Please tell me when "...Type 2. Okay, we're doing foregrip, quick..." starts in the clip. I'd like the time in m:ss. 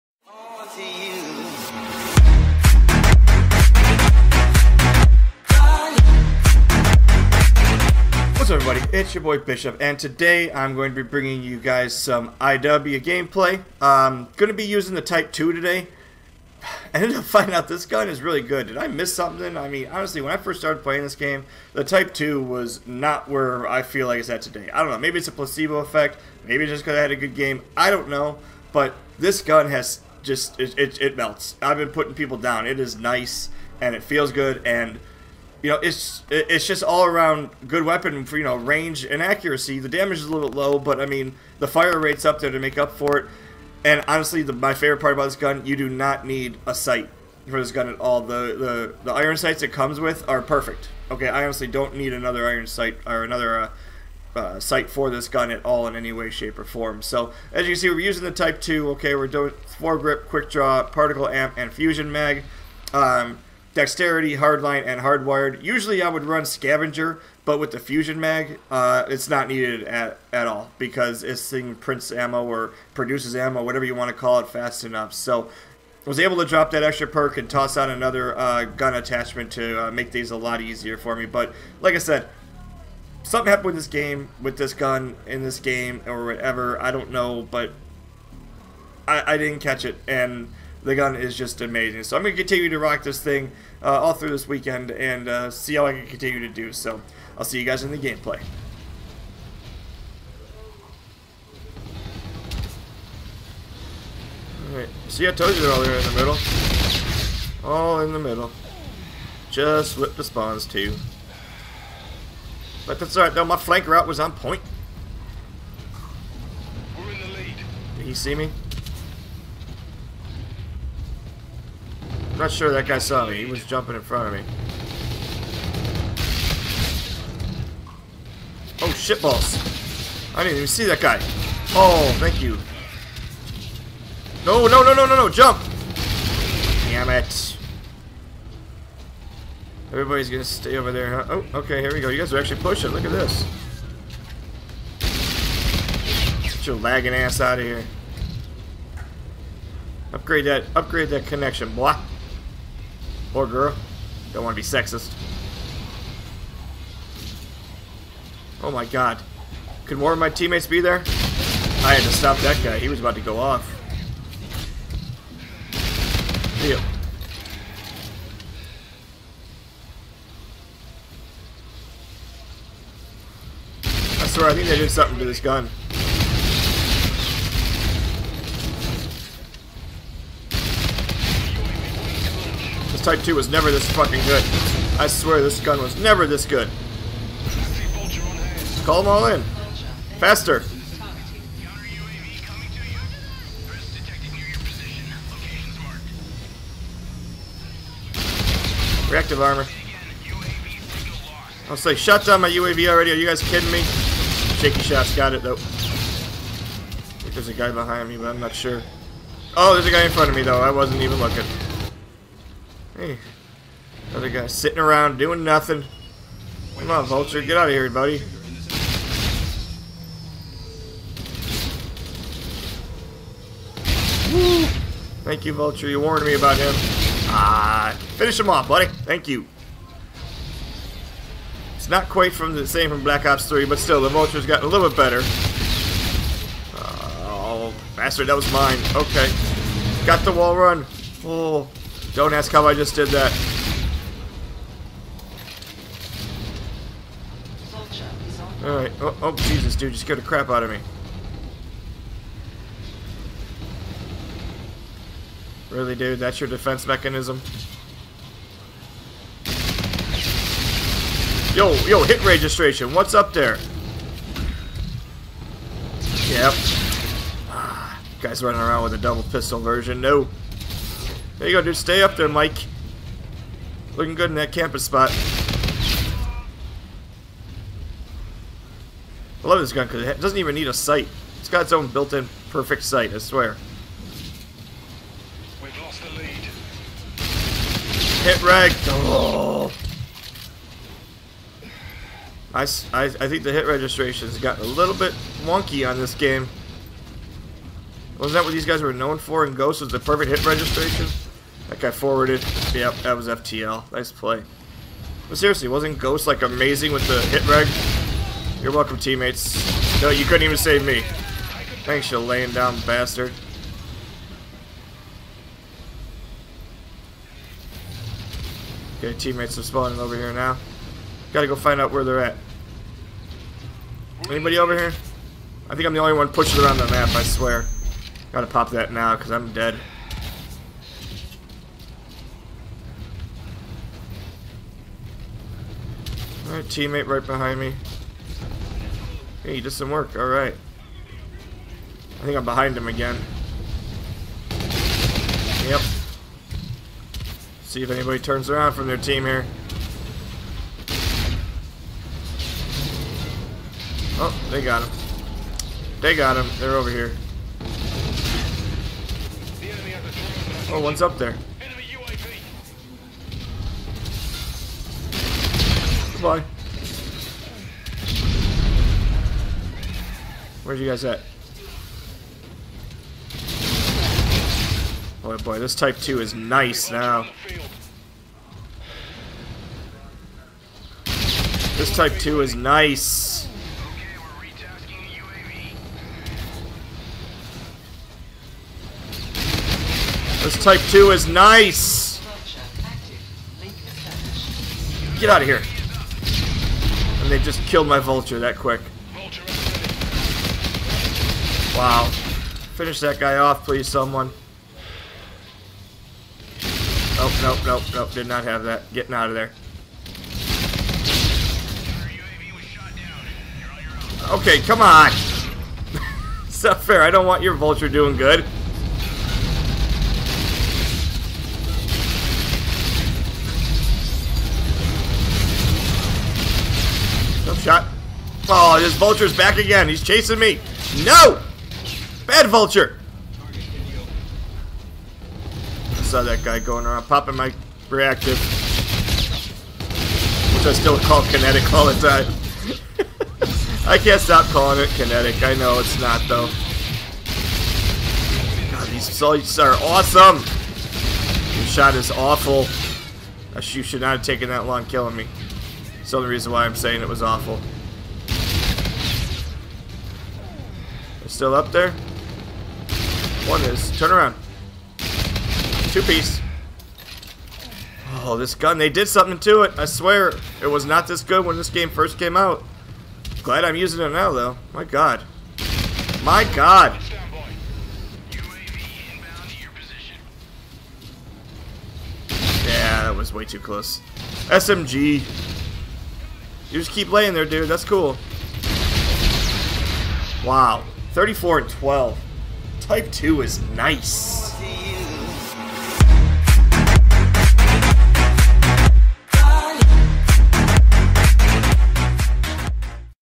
0:58.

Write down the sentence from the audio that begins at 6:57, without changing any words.
I don't want your vulture doing good.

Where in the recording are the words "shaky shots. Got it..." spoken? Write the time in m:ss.
3:24.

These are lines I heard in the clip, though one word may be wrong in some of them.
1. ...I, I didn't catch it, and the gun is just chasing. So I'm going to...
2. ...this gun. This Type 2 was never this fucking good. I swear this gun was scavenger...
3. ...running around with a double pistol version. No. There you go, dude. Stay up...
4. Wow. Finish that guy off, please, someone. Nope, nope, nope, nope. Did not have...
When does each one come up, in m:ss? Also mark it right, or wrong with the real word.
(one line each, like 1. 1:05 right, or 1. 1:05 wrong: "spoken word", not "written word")
1. 1:29 wrong: "amazing", not "chasing"
2. 2:55 wrong: "never", not "scavenger"
3. 4:28 right
4. 6:41 right.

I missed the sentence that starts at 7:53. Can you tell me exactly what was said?
Glad I'm using it now, though.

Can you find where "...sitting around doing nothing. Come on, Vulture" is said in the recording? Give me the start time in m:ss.
3:34.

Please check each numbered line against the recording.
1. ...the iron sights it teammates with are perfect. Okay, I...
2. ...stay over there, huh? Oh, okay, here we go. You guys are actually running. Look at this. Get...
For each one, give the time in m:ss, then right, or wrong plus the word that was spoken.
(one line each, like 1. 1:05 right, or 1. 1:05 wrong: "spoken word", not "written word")
1. 0:49 wrong: "comes", not "teammates"
2. 2:20 wrong: "pushing", not "running".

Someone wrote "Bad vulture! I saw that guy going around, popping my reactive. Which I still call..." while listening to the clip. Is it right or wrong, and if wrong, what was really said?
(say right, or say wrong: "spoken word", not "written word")
right.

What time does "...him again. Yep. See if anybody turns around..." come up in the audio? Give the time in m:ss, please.
5:42.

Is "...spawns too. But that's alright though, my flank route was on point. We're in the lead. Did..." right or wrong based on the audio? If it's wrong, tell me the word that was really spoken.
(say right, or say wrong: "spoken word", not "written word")
right.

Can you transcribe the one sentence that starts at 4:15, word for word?
Really, dude, that's your defense mechanism?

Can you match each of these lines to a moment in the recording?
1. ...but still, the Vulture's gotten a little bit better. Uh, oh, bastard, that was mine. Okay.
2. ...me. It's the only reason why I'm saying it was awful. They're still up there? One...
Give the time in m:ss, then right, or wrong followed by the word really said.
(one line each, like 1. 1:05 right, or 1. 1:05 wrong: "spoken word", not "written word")
1. 3:53 right
2. 7:35 right.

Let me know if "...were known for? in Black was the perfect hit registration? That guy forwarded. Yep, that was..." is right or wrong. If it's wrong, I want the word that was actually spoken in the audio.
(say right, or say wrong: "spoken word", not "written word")
wrong: "Ghost", not "Black".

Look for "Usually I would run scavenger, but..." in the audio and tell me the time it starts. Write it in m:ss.
1:05.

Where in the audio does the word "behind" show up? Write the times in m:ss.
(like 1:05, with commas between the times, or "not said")
3:27, 5:37, 5:42.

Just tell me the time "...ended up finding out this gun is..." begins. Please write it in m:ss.
0:17.